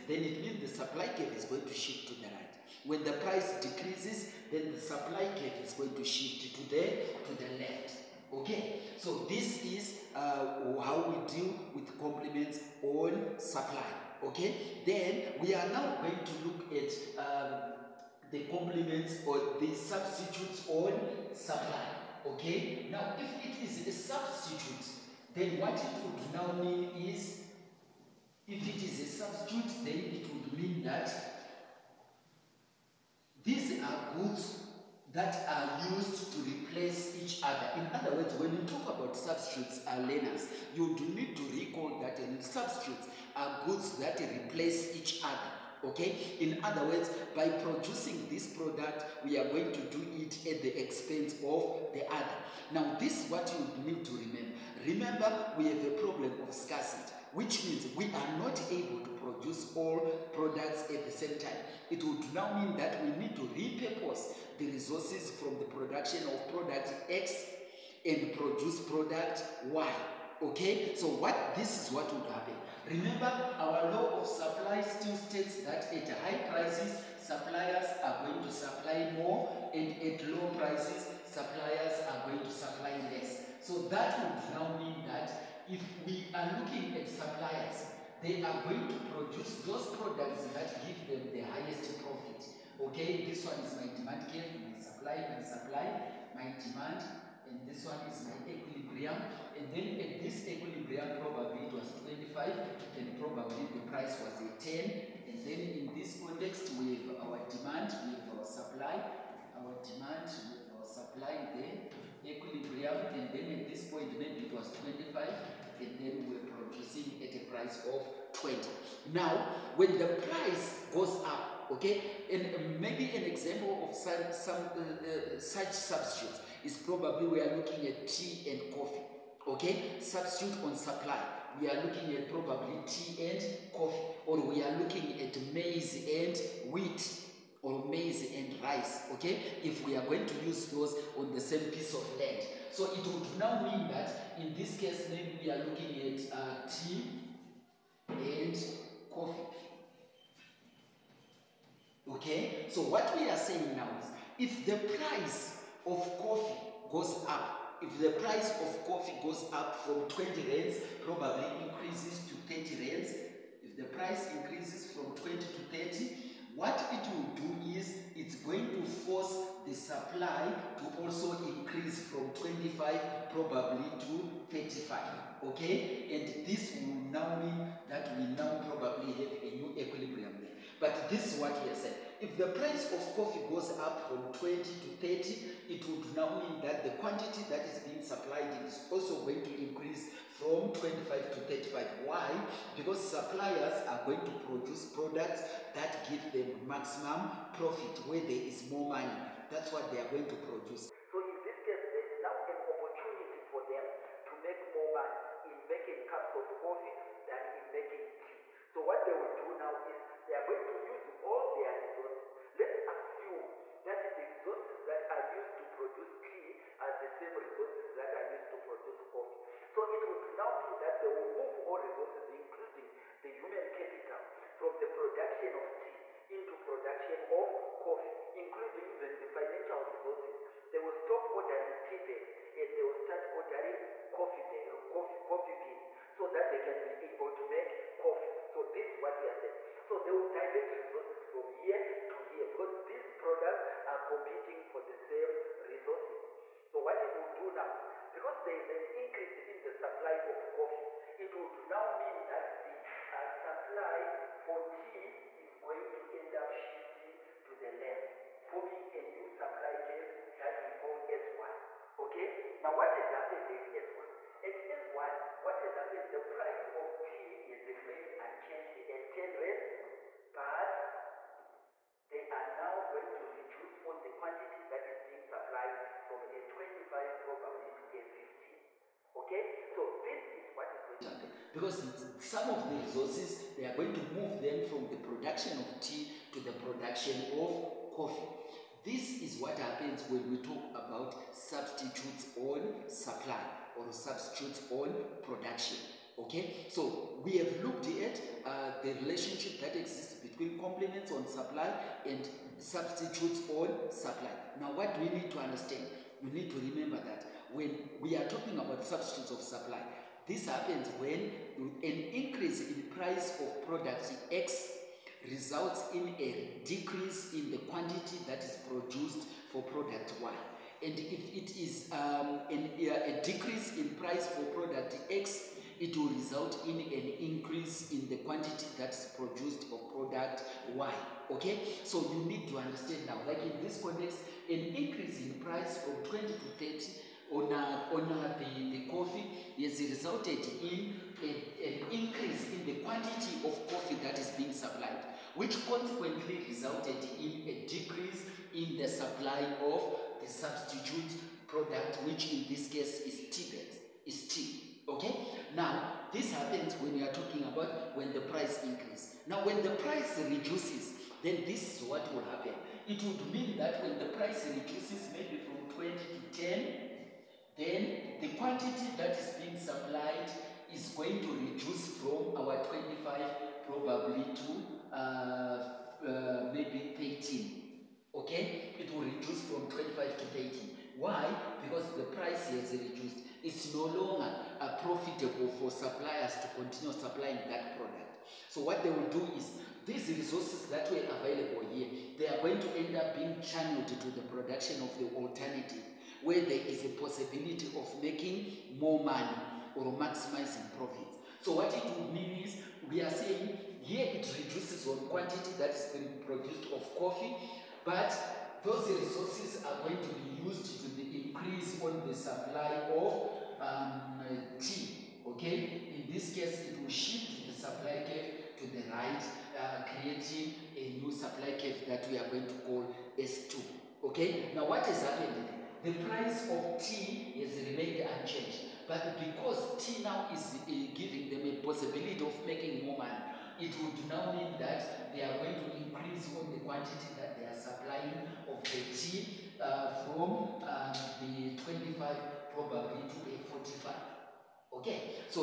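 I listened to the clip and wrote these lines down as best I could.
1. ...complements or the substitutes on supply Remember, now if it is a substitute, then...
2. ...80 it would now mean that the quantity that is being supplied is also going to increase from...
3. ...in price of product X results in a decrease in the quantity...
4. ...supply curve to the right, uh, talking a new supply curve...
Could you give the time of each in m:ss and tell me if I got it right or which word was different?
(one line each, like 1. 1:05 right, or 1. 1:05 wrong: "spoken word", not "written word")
1. 0:18 wrong: "Okay", not "Remember"
2. 3:05 wrong: "30", not "80"
3. 5:12 right
4. 6:57 wrong: "creating", not "talking".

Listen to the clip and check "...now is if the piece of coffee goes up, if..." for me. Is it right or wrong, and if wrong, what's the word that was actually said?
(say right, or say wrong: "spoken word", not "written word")
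wrong: "price", not "piece".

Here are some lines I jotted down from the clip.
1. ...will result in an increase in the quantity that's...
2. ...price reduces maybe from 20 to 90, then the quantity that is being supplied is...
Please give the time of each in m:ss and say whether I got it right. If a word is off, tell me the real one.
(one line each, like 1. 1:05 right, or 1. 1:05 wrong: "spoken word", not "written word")
1. 5:25 right
2. 6:04 wrong: "10", not "90".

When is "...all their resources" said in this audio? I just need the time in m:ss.
3:31.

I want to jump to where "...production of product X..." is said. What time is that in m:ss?
1:05.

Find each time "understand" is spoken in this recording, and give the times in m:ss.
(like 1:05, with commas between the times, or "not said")
5:05, 5:32.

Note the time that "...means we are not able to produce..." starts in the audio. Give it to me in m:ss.
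0:57.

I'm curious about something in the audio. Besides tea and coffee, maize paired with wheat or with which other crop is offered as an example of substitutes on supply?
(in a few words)
rice.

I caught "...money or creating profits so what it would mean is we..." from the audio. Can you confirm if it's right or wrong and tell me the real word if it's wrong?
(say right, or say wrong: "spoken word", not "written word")
wrong: "maximizing", not "creating".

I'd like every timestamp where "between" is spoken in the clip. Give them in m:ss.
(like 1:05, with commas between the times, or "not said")
5:00.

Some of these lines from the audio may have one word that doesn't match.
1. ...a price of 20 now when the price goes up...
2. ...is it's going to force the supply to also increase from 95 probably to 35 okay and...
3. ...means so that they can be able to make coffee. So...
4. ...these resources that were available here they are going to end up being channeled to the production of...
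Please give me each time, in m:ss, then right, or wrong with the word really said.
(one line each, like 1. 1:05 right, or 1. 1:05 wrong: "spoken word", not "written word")
1. 1:57 right
2. 2:47 wrong: "25", not "95"
3. 3:55 wrong: "beans", not "means"
4. 6:29 right.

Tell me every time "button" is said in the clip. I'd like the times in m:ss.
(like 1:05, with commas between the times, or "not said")
not said.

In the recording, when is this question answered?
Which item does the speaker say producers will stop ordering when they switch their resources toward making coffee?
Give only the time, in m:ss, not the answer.
3:51.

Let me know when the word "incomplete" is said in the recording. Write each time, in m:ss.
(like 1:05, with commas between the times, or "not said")
not said.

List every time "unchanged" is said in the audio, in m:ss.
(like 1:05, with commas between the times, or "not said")
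4:28, 7:08.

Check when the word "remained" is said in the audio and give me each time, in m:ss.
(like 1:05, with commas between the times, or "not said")
4:27, 7:07.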